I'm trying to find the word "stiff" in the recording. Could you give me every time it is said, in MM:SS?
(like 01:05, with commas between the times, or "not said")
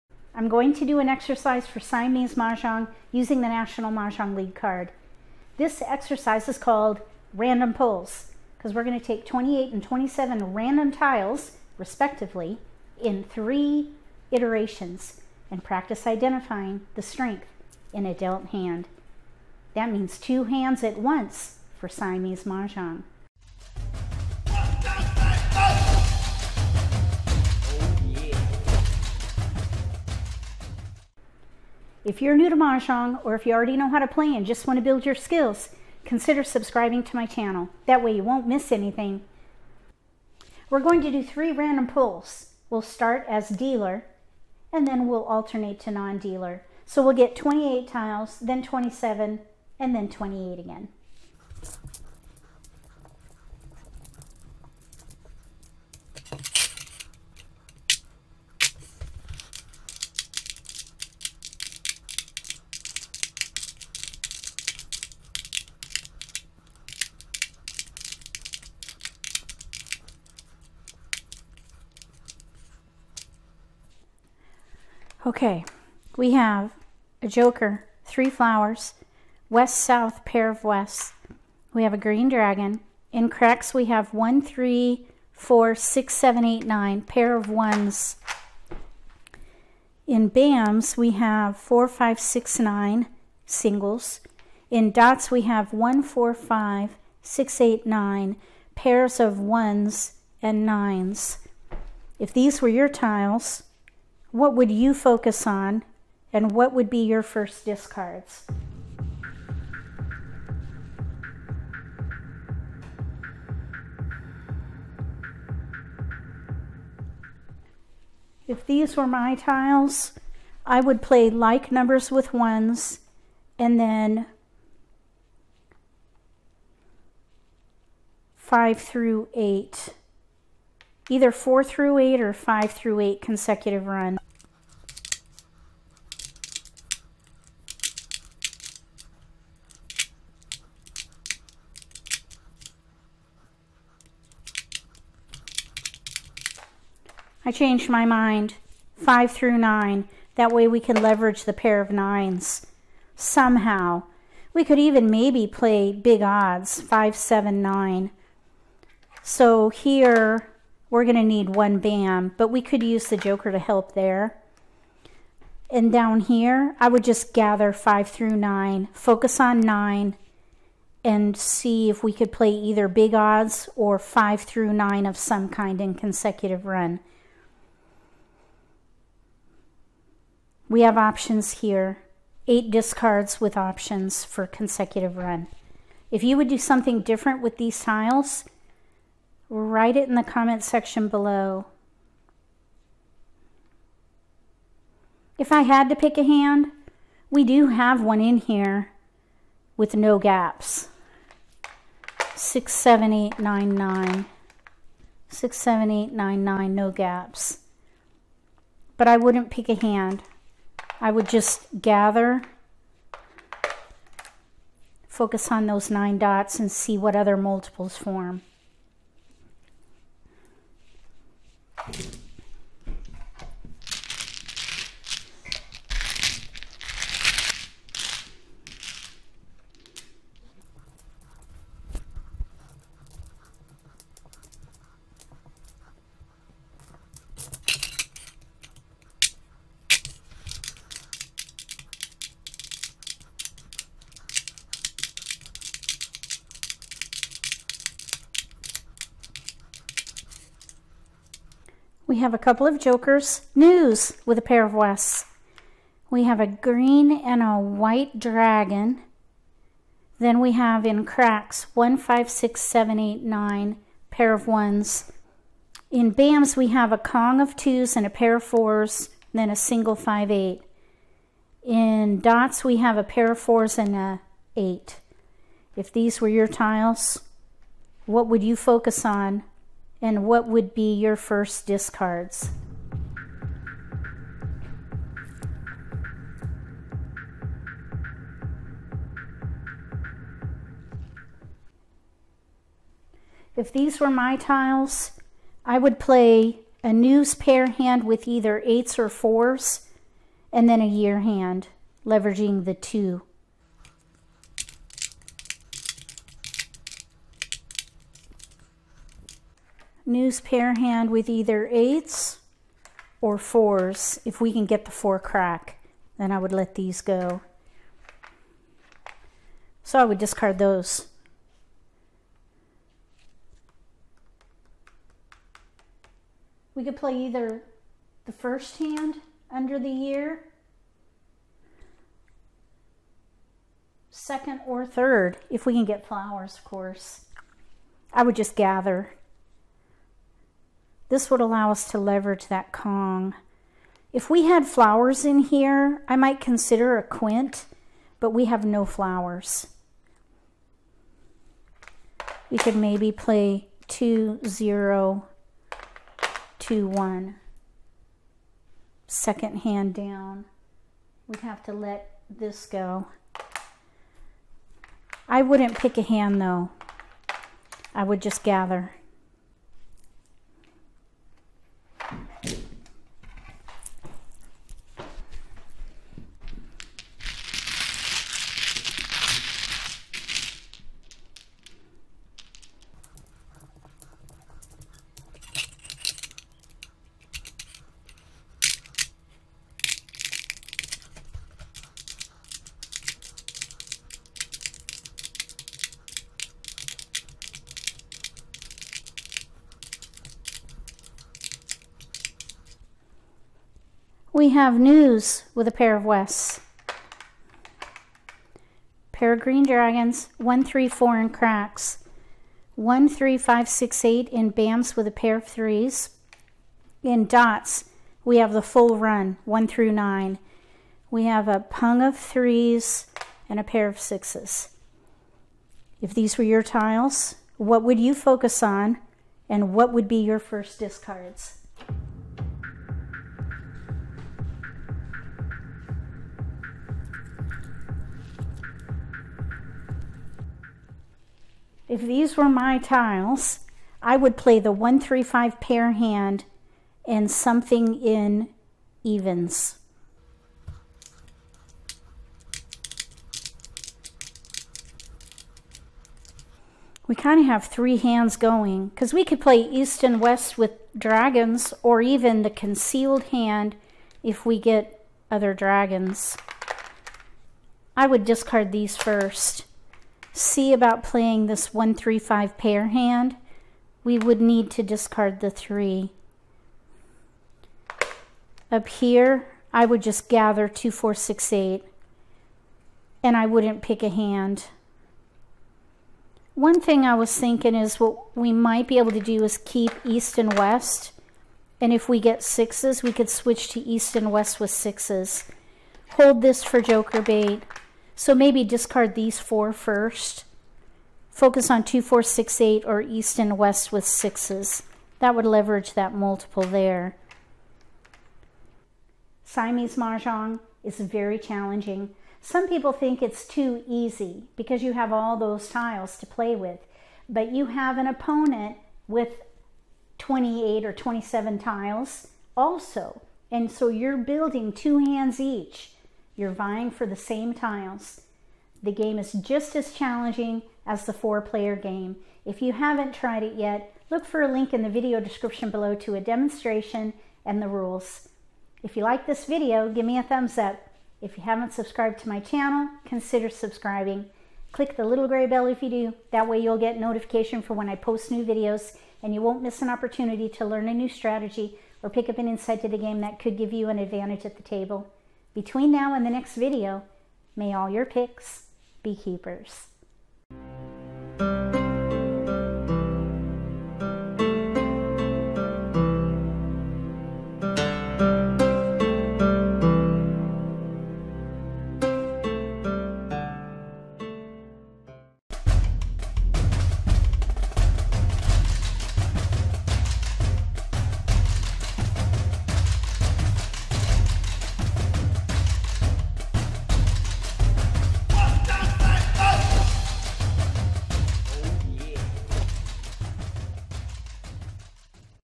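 not said.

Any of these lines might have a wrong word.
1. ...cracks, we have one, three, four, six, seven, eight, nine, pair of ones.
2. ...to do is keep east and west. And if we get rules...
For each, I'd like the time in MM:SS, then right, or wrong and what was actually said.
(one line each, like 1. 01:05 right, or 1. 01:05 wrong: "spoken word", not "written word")
1. 01:23 right
2. 08:09 wrong: "sixes", not "rules".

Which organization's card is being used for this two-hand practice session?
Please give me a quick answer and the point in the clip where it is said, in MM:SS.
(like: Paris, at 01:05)
National Mahjong League, at 00:03.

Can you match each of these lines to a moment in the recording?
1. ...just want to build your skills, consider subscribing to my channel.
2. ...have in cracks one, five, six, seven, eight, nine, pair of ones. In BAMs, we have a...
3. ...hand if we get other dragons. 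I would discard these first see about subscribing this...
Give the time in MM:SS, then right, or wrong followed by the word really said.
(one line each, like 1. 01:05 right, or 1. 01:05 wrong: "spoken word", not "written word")
1. 00:34 right
2. 04:20 right
3. 07:43 wrong: "playing", not "subscribing".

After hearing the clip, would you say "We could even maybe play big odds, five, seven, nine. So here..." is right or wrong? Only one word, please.
right.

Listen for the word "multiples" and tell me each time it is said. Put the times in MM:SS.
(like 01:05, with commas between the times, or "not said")
03:37, 08:26.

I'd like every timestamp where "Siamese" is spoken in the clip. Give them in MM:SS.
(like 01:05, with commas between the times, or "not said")
00:01, 00:21, 08:29.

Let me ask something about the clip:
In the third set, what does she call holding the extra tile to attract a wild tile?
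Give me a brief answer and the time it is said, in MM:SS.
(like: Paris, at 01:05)
joker bait, at 08:16.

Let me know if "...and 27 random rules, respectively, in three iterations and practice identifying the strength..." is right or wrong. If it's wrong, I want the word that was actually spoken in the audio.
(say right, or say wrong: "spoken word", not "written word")
wrong: "tiles", not "rules".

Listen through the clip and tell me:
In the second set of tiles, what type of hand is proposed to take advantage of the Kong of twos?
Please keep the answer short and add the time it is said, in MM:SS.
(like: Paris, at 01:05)
a year hand, at 05:00.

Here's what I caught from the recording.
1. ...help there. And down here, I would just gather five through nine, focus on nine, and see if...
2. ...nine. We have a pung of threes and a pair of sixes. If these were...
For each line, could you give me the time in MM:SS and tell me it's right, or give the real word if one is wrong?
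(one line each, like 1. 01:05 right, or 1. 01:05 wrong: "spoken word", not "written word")
1. 02:43 right
2. 06:59 right.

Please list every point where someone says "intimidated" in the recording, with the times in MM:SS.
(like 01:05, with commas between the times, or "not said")
not said.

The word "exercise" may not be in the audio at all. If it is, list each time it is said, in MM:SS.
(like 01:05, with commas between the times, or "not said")
00:01, 00:05.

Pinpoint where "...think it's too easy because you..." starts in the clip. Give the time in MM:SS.
08:32.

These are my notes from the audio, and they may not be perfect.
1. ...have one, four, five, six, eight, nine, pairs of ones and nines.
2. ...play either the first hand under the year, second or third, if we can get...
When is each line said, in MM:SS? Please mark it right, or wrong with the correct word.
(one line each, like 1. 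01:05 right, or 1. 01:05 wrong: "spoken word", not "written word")
1. 01:35 right
2. 05:26 right.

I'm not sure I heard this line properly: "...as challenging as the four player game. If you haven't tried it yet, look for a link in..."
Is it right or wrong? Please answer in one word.
right.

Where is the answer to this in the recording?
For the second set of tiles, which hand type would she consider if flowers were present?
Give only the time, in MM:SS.
05:46.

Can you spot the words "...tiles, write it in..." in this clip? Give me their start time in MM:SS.
03:07.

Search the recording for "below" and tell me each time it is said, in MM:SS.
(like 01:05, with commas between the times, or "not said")
03:11, 08:55.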